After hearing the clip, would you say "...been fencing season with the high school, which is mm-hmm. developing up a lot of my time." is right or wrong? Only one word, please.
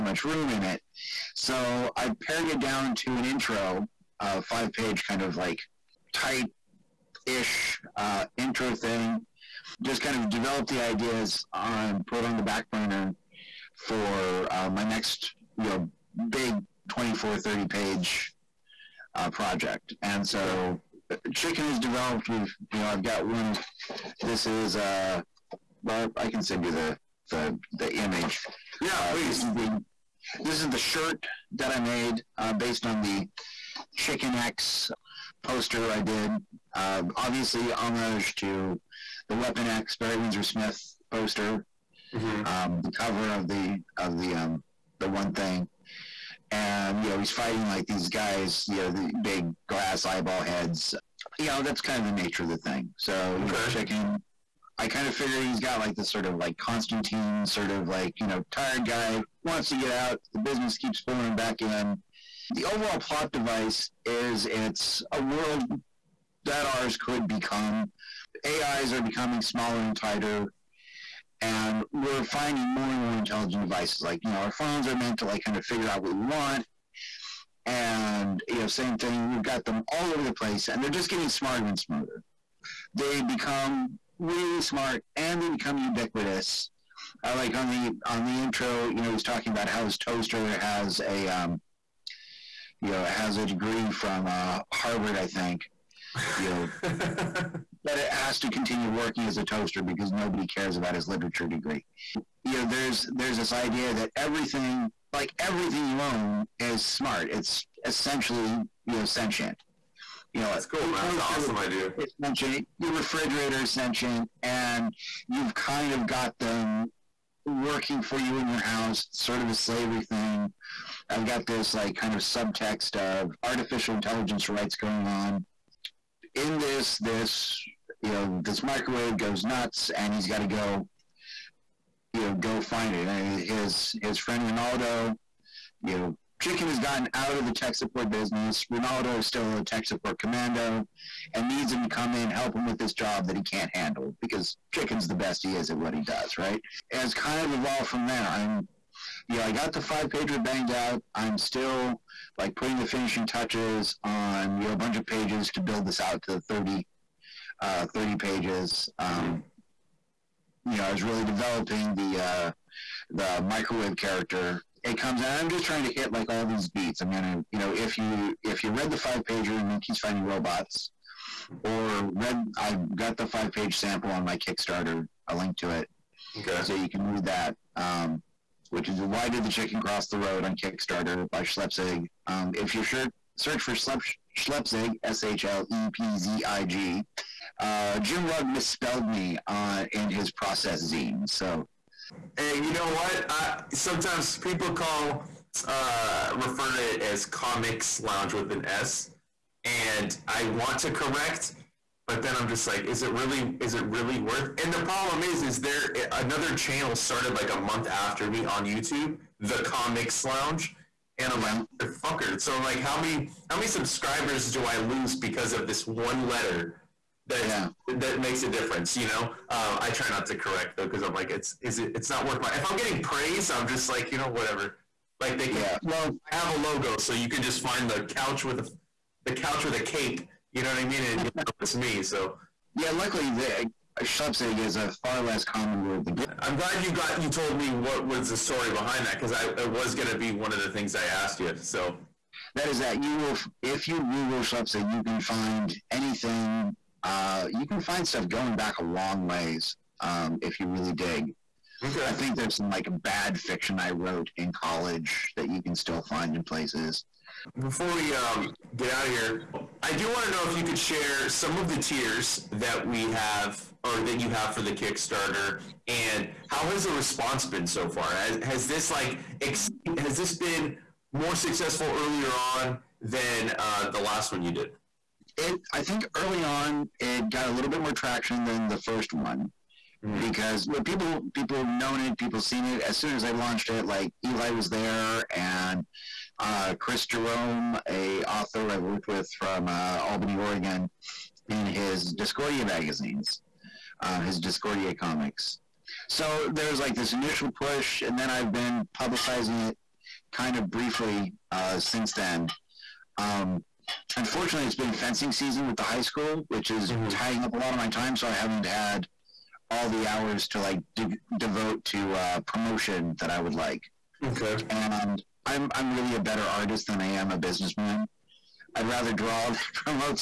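wrong.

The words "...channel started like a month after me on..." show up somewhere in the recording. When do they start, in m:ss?
3:26.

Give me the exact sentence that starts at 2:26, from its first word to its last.
Has kind of evolved from there.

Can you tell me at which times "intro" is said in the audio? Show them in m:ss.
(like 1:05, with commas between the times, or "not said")
0:03, 0:08, 1:28.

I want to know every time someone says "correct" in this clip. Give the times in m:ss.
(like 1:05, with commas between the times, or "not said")
3:20, 3:40.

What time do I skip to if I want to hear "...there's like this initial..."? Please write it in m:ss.
4:56.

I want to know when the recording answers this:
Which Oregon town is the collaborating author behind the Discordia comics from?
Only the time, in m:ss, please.
4:50.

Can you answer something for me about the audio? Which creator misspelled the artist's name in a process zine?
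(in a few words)
Jim Rugg.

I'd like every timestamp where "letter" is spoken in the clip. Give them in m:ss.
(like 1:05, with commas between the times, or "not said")
3:36.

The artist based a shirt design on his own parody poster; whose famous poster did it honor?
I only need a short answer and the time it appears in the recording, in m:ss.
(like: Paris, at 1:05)
Barry Windsor Smith, at 0:39.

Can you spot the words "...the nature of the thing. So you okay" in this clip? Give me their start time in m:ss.
0:52.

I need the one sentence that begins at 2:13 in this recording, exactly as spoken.
And his, his friend Ronaldo, you know, Chicken has gotten out of the tech support business.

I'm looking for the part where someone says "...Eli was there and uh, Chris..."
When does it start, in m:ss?
4:44.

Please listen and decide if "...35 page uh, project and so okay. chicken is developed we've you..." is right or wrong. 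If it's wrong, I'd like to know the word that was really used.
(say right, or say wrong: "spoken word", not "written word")
wrong: "30", not "35".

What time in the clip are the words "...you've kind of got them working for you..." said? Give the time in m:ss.
1:55.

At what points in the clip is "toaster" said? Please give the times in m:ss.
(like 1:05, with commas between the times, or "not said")
1:29, 1:39, 1:51.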